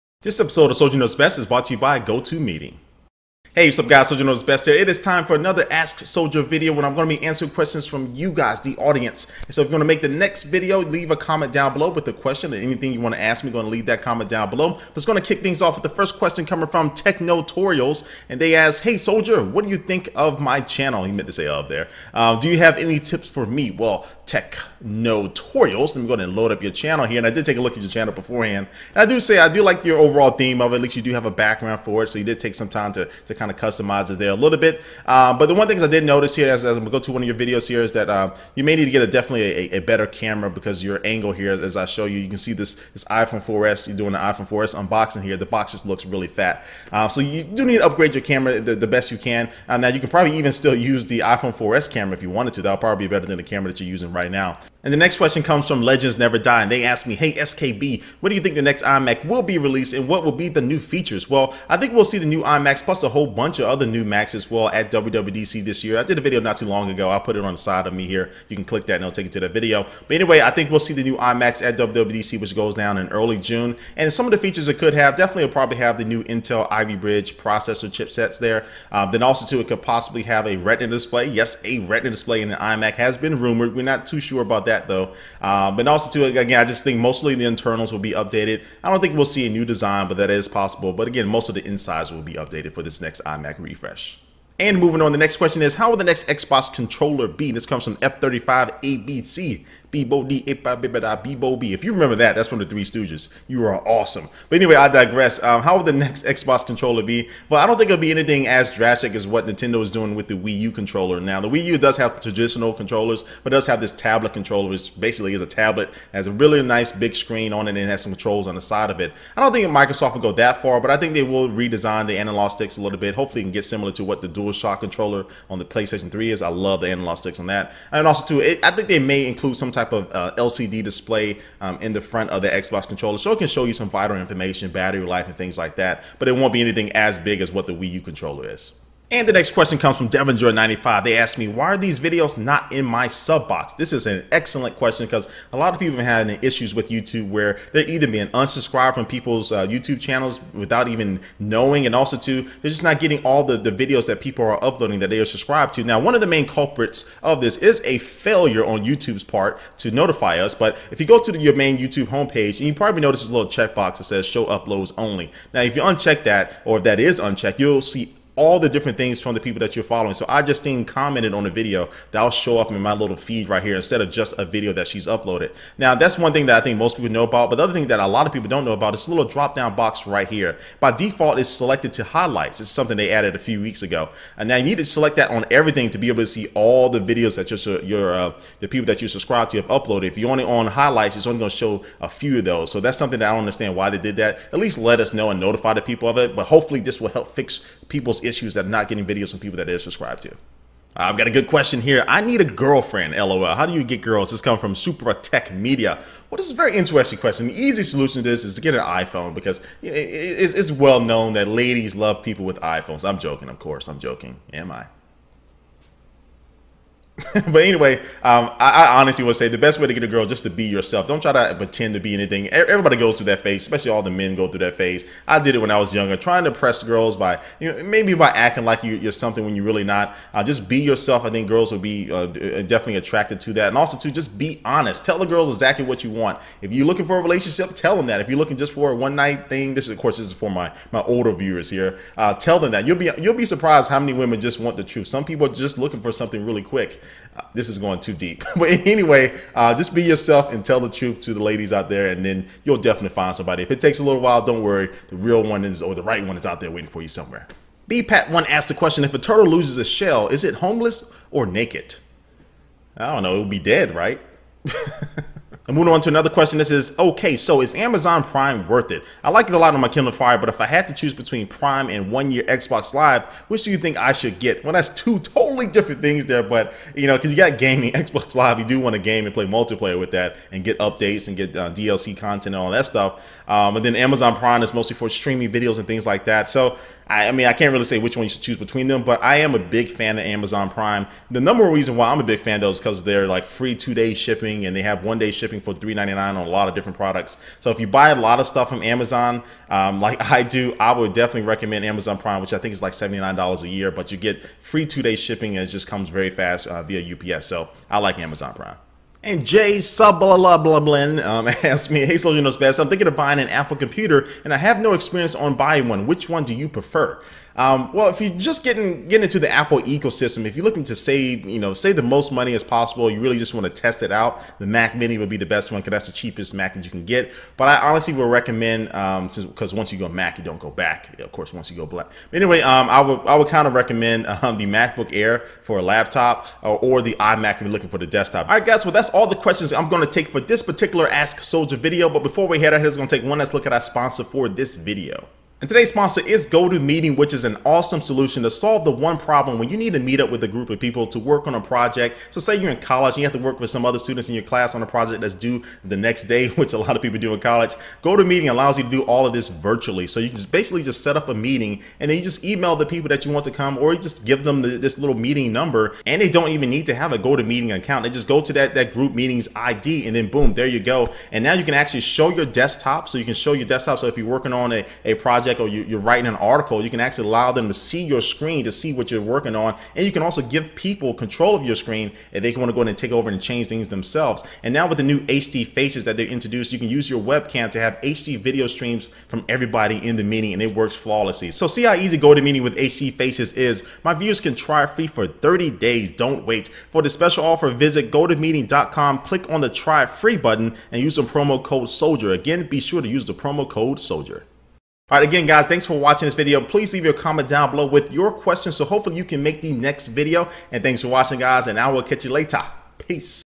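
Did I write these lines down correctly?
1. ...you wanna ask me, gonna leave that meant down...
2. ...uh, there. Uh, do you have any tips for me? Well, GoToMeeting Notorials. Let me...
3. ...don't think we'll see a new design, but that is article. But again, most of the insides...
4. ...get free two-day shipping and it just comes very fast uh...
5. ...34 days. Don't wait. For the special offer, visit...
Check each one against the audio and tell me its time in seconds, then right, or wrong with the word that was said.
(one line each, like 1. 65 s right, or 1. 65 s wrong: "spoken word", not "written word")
1. 12 s wrong: "comment", not "meant"
2. 21 s wrong: "Tech", not "GoToMeeting"
3. 88 s wrong: "possible", not "article"
4. 304 s right
5. 395 s wrong: "30", not "34".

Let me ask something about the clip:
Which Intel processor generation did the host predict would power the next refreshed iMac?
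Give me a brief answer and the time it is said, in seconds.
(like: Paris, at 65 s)
Ivy Bridge, at 76 s.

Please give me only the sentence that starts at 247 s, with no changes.
Uh, this is going too deep.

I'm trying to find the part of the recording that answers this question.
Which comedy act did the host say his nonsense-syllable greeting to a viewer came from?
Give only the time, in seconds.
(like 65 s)
102 s.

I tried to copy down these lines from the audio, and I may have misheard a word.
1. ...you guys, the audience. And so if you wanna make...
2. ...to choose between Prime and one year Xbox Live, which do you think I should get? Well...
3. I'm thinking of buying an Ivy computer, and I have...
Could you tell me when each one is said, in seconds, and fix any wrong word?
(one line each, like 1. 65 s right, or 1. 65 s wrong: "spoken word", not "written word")
1. 8 s right
2. 270 s right
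3. 312 s wrong: "Apple", not "Ivy".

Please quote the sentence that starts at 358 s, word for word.
GoToMeeting allows you to do all of this virtually.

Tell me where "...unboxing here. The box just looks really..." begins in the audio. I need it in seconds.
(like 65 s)
44 s.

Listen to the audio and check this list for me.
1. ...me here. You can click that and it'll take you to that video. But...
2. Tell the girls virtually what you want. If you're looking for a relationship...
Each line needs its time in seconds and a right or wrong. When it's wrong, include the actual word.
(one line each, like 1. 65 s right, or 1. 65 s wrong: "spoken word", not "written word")
1. 67 s right
2. 235 s wrong: "exactly", not "virtually".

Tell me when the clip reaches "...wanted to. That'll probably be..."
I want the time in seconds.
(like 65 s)
52 s.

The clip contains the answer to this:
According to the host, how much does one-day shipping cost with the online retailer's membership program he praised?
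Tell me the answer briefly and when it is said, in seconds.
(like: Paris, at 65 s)
$3.99, at 295 s.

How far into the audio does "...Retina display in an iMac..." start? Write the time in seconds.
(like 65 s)
81 s.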